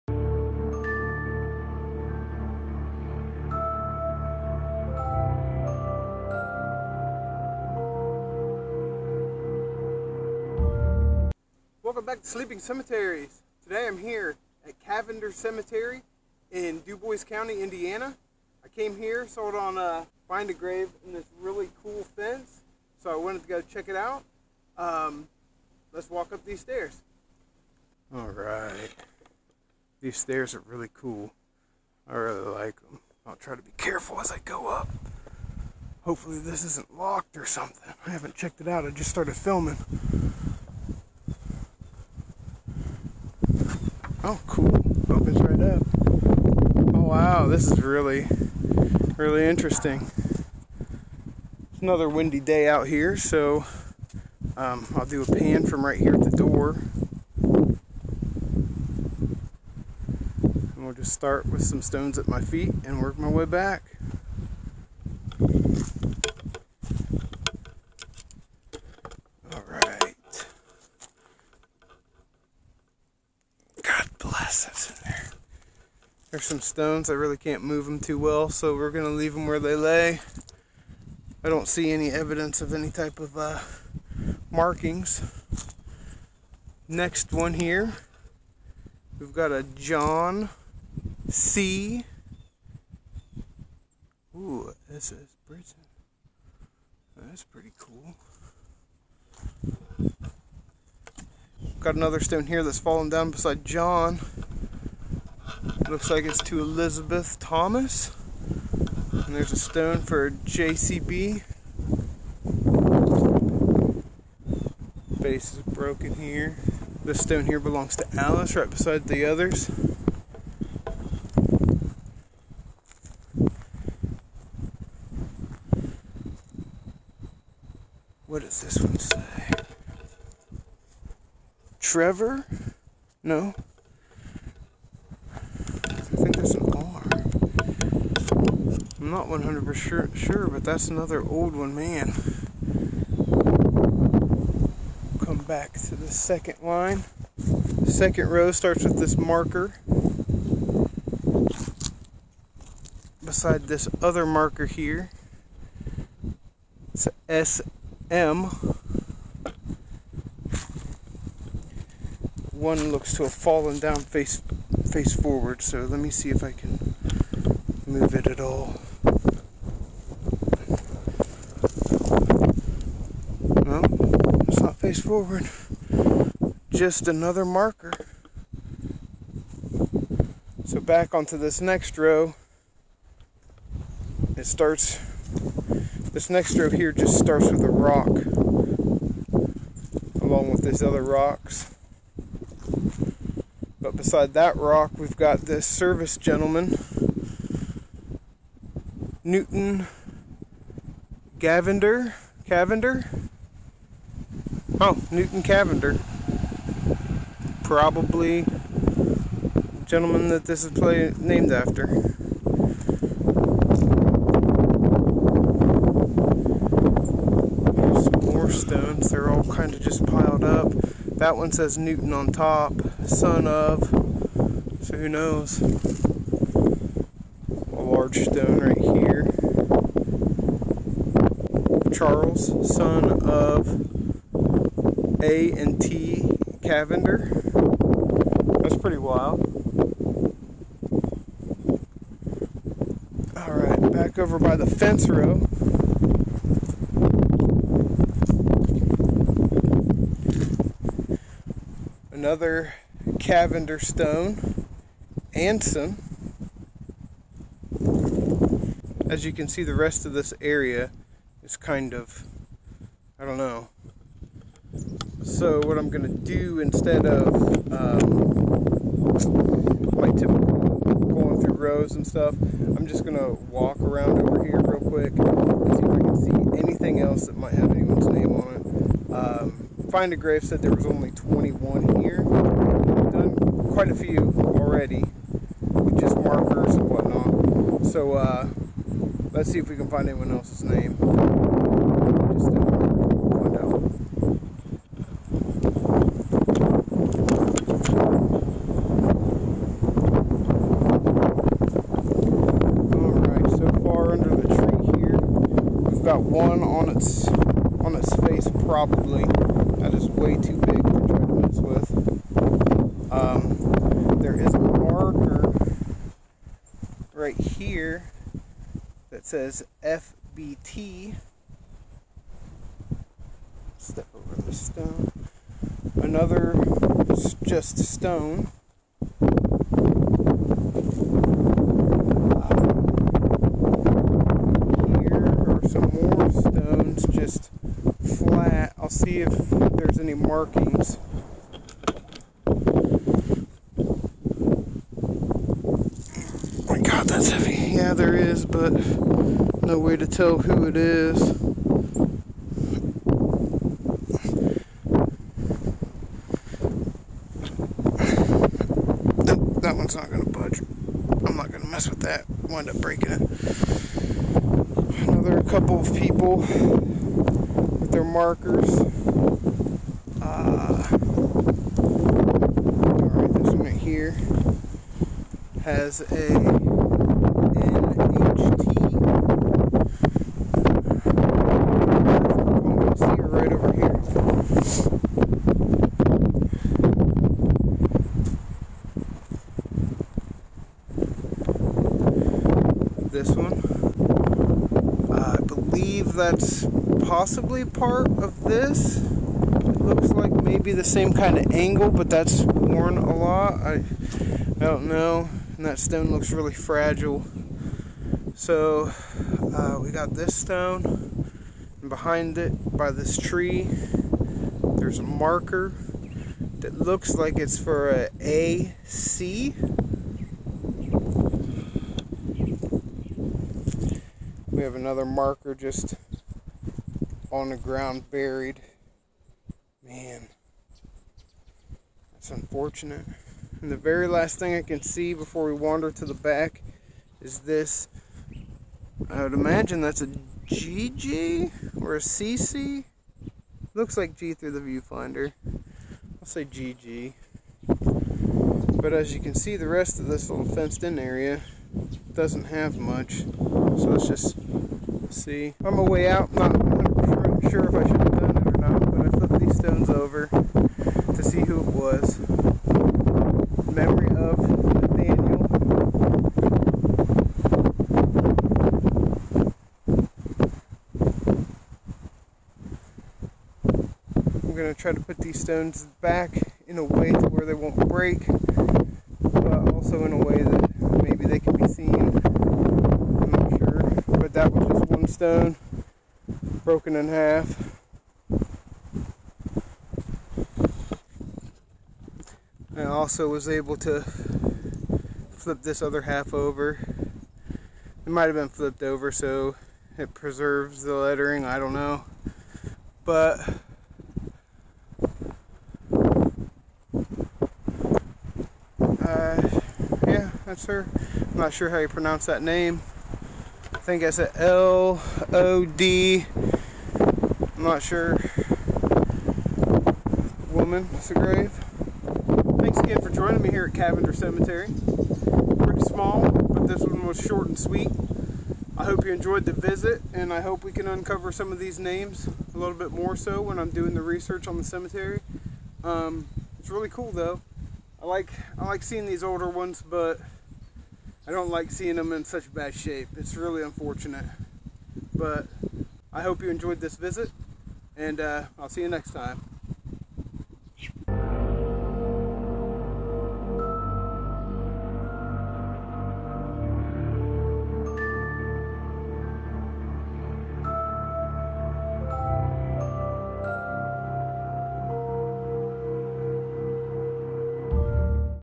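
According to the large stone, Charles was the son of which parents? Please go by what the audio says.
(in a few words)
A and T Cavender.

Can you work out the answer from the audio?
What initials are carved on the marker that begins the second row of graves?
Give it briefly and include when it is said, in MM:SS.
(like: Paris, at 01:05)
SM, at 02:37.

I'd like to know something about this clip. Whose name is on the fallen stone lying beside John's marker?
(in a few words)
Elizabeth Thomas.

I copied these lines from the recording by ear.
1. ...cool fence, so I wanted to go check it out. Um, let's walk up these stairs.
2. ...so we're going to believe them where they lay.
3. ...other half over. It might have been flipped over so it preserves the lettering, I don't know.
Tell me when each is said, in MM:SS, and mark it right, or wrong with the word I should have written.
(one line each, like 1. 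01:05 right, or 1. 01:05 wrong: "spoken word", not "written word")
1. 00:21 right
2. 01:18 wrong: "leave", not "believe"
3. 08:15 right.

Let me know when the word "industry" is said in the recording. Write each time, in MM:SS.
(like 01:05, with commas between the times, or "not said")
not said.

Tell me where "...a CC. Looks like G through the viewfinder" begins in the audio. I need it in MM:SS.
07:21.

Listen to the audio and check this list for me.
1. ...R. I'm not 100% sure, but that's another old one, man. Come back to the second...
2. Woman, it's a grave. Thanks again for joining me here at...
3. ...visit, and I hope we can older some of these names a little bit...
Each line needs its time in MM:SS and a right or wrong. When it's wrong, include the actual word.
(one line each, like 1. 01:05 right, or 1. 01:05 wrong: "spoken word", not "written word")
1. 02:16 right
2. 08:40 right
3. 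08:49 wrong: "uncover", not "older".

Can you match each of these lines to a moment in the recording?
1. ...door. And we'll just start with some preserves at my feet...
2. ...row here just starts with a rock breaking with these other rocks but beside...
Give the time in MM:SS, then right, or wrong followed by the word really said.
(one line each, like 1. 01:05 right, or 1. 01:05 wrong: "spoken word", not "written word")
1. 00:56 wrong: "stones", not "preserves"
2. 03:06 wrong: "along", not "breaking".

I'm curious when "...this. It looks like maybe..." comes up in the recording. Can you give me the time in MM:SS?
06:38.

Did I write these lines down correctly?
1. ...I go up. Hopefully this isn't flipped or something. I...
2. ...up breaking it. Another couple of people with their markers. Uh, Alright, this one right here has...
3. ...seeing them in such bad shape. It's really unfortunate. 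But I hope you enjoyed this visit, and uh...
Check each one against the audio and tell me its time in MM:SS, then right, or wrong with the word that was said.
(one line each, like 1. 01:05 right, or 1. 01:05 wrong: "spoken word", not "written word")
1. 00:34 wrong: "locked", not "flipped"
2. 06:02 right
3. 09:01 right.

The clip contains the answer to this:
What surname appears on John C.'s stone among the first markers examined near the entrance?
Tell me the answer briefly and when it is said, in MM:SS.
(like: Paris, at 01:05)
Brittain, at 01:35.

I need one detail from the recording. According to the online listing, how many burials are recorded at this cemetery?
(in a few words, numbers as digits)
21.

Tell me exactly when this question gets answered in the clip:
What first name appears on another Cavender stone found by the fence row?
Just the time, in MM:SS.
04:15.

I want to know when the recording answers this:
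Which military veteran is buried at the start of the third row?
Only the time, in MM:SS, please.
03:25.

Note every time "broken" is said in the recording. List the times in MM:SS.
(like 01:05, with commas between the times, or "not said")
01:55, 08:06.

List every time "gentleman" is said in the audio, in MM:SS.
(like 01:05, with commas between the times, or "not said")
03:16, 03:29.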